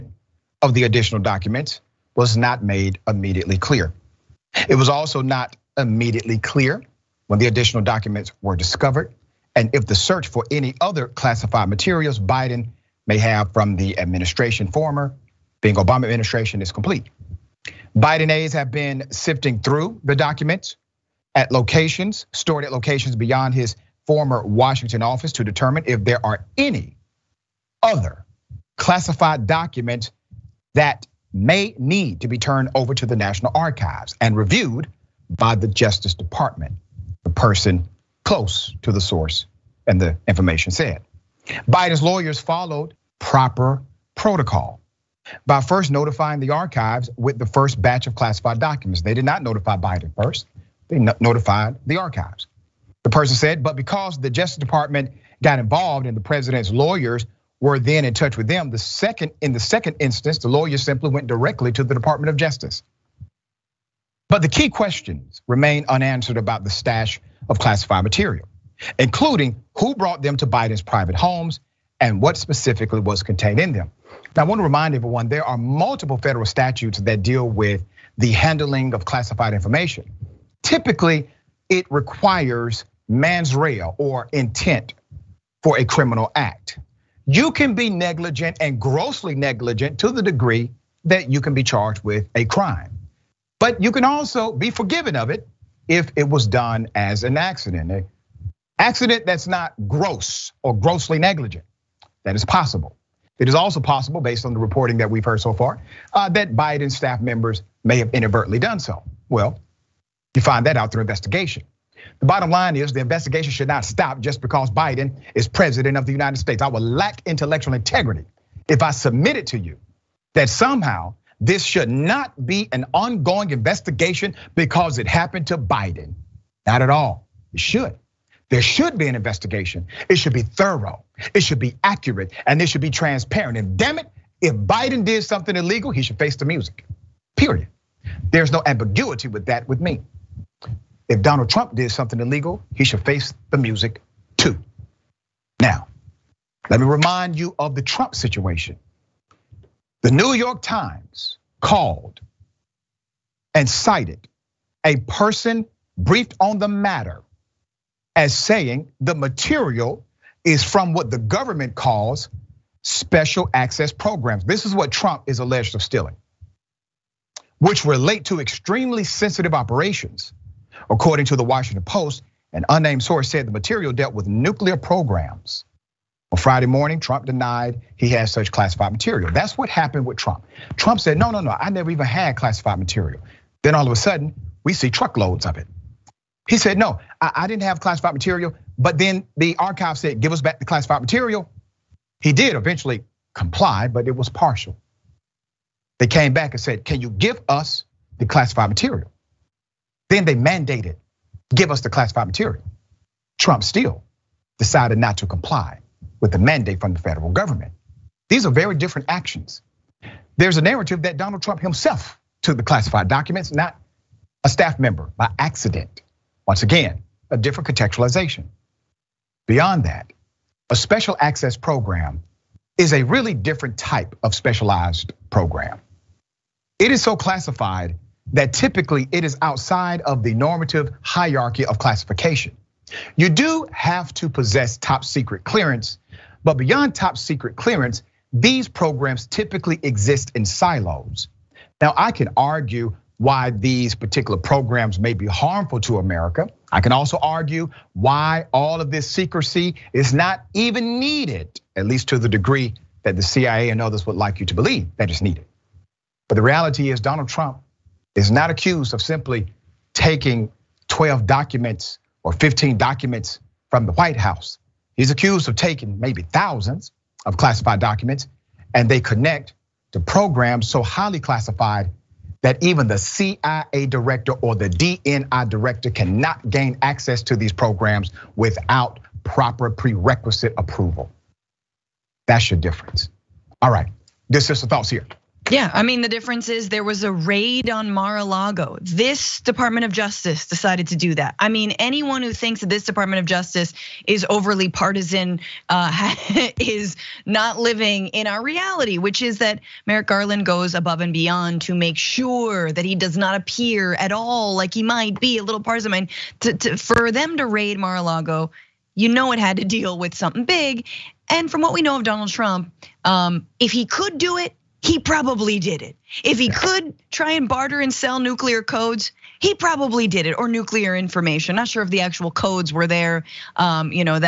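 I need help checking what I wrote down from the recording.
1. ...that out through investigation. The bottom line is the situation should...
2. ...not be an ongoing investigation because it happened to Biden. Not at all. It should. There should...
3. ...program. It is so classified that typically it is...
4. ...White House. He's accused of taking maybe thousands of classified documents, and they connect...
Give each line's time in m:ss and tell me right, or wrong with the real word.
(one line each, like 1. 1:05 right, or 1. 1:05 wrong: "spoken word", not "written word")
1. 1:50 wrong: "investigation", not "situation"
2. 2:01 right
3. 3:45 right
4. 4:23 right.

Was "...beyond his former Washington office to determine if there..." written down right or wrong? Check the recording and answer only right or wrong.
right.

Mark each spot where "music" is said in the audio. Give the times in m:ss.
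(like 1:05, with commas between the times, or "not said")
2:16, 2:23.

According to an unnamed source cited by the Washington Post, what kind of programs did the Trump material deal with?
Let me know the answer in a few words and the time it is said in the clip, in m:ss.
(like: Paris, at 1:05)
Nuclear programs, at 2:54.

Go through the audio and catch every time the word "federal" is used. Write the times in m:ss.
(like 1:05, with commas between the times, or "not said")
1:16, 3:26.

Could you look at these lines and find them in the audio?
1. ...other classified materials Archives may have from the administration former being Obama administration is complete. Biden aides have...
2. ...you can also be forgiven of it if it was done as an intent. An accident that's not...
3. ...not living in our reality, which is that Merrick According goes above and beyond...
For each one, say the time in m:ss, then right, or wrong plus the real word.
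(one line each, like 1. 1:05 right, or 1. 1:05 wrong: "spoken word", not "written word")
1. 0:10 wrong: "Biden", not "Archives"
2. 1:33 wrong: "accident", not "intent"
3. 4:57 wrong: "Garland", not "According".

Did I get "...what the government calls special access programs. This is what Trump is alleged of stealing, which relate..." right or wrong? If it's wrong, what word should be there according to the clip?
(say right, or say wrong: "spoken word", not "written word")
right.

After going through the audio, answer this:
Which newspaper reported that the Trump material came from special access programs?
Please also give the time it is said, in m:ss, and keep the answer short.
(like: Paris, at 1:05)
The New York Times, at 2:30.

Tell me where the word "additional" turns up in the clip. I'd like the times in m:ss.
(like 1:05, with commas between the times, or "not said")
0:00, 0:07.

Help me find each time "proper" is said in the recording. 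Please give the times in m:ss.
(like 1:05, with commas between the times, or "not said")
0:43, 4:39.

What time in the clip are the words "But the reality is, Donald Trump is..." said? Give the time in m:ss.
4:16.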